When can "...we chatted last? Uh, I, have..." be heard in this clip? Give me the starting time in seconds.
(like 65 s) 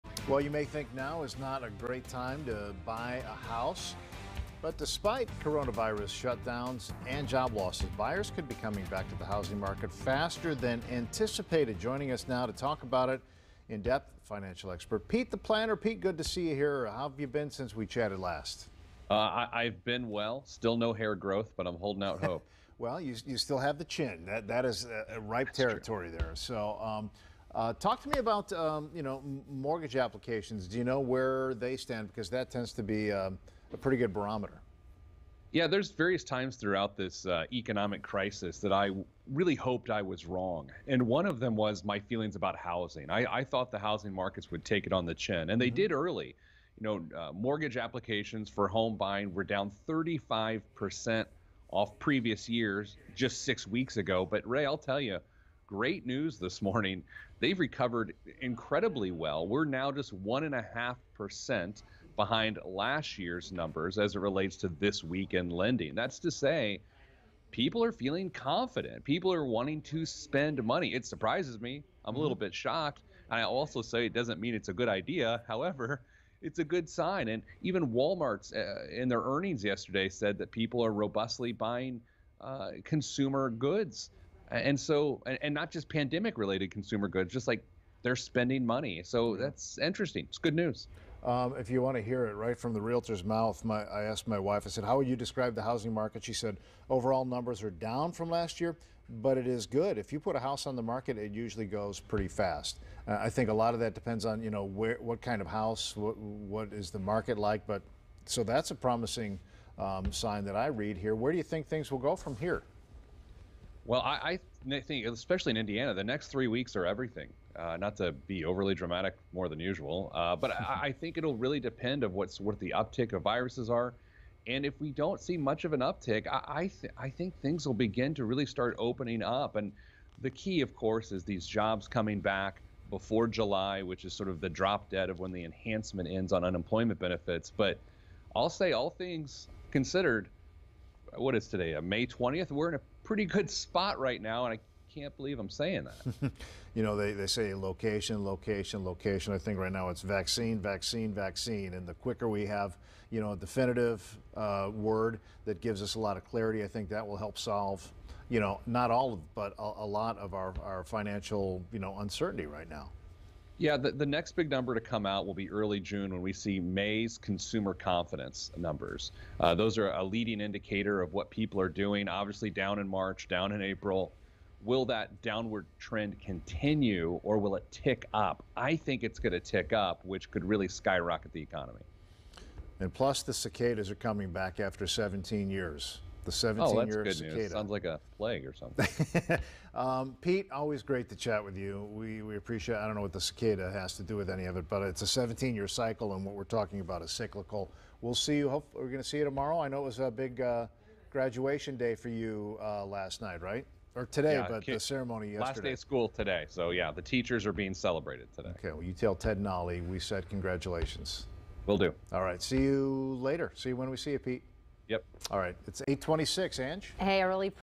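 17 s.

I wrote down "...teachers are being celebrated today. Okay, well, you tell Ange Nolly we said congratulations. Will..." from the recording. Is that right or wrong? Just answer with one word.
wrong.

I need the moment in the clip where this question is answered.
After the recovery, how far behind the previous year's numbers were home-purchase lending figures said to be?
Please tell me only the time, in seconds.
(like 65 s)
60 s.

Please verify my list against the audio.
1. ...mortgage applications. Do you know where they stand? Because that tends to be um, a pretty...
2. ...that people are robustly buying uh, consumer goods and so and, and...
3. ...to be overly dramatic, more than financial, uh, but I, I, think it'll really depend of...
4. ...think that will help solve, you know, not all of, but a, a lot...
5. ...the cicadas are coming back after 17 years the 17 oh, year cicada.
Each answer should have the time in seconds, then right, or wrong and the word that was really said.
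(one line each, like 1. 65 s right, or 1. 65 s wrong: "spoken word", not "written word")
1. 29 s right
2. 80 s right
3. 117 s wrong: "usual", not "financial"
4. 156 s right
5. 183 s right.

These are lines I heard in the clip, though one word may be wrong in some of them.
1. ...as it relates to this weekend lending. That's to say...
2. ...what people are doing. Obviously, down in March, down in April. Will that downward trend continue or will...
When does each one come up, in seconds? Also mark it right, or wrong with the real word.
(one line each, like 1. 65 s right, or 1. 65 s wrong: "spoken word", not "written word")
1. 63 s right
2. 171 s right.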